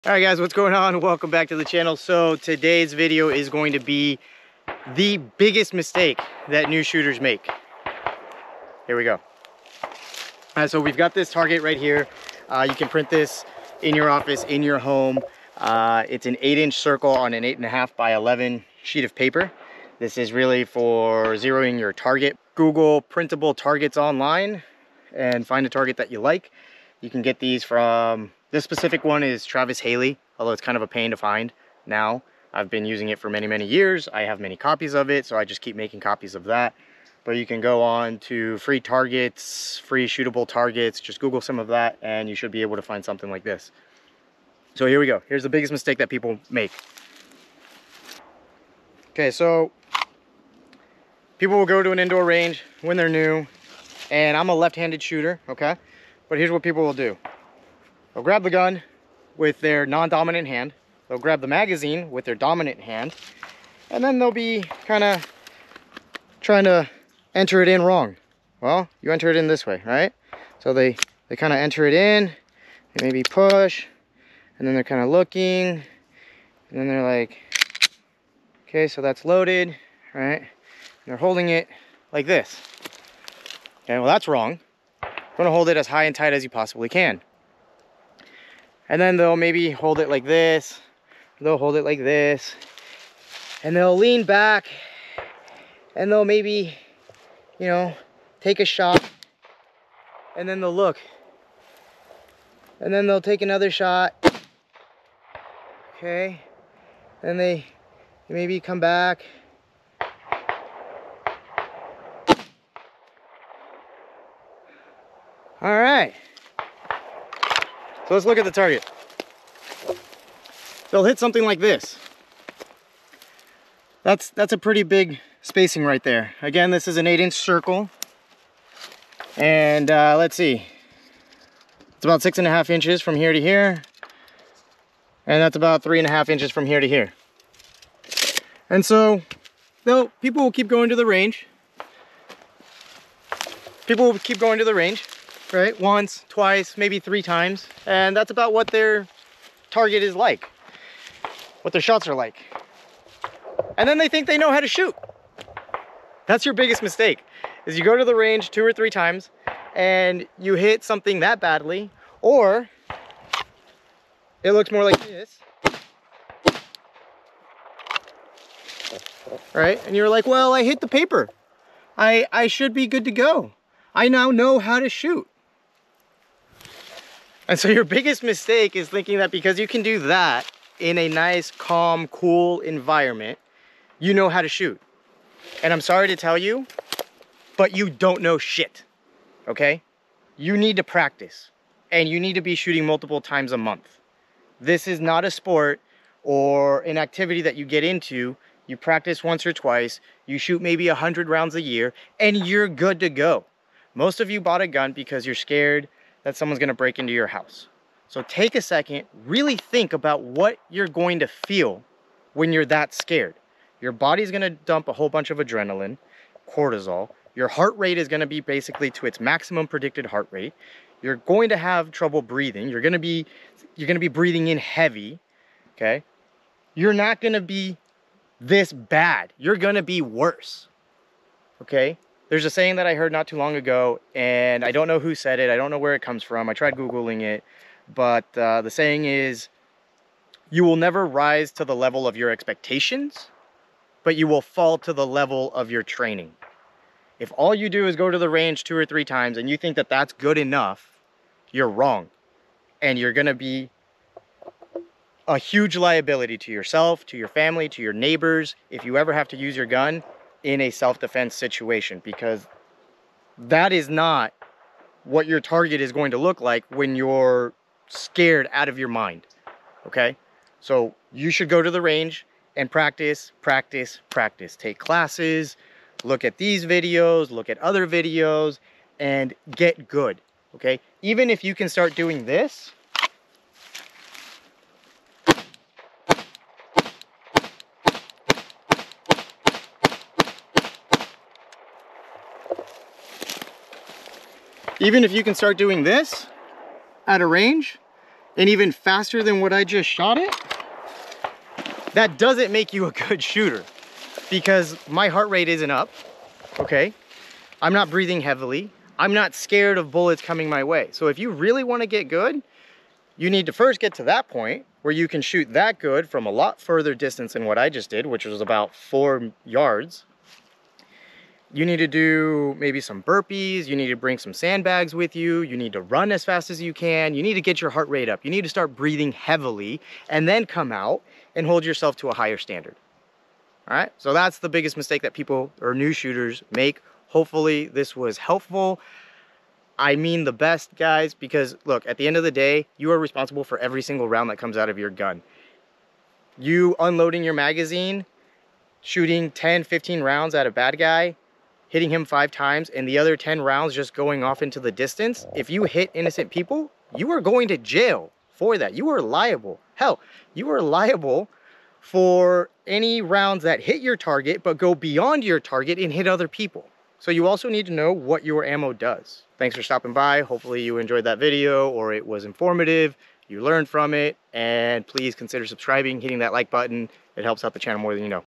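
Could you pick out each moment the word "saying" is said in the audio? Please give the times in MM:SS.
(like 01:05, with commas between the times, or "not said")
03:52, 03:58.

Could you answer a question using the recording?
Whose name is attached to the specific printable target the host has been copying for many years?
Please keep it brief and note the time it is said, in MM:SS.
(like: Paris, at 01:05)
Travis Haley, at 00:29.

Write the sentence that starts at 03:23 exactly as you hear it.
Most of you bought a gun because you're scared, that someone's gonna break into your house.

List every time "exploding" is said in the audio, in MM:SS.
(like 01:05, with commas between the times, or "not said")
not said.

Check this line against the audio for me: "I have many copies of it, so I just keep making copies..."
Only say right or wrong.
right.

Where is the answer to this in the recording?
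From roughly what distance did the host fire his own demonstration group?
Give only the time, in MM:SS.
05:18.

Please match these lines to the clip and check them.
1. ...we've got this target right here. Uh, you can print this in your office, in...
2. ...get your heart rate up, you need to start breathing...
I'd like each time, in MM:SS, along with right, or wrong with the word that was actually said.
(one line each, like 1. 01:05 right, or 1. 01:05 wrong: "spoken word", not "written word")
1. 00:10 right
2. 05:27 right.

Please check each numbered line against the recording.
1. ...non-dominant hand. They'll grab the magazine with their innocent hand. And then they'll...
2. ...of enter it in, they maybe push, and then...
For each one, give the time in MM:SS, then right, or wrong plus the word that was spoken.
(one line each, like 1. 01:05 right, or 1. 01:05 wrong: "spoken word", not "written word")
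1. 00:59 wrong: "dominant", not "innocent"
2. 01:11 right.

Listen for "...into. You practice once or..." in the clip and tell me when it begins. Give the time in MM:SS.
03:17.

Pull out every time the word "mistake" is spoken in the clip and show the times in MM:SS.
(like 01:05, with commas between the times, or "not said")
00:05, 00:45, 02:36, 02:58, 05:34.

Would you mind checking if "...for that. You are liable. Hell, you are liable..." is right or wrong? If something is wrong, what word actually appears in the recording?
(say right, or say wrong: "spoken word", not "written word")
right.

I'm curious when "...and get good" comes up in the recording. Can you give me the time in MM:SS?
04:38.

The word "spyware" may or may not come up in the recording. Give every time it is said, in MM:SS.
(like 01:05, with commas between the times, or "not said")
not said.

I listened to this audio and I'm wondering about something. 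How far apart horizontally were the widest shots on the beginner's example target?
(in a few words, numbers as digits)
6.5 inches.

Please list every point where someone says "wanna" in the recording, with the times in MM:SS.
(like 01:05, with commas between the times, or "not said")
01:25, 05:11.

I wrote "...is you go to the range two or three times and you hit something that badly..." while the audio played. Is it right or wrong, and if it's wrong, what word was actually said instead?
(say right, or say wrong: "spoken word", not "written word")
right.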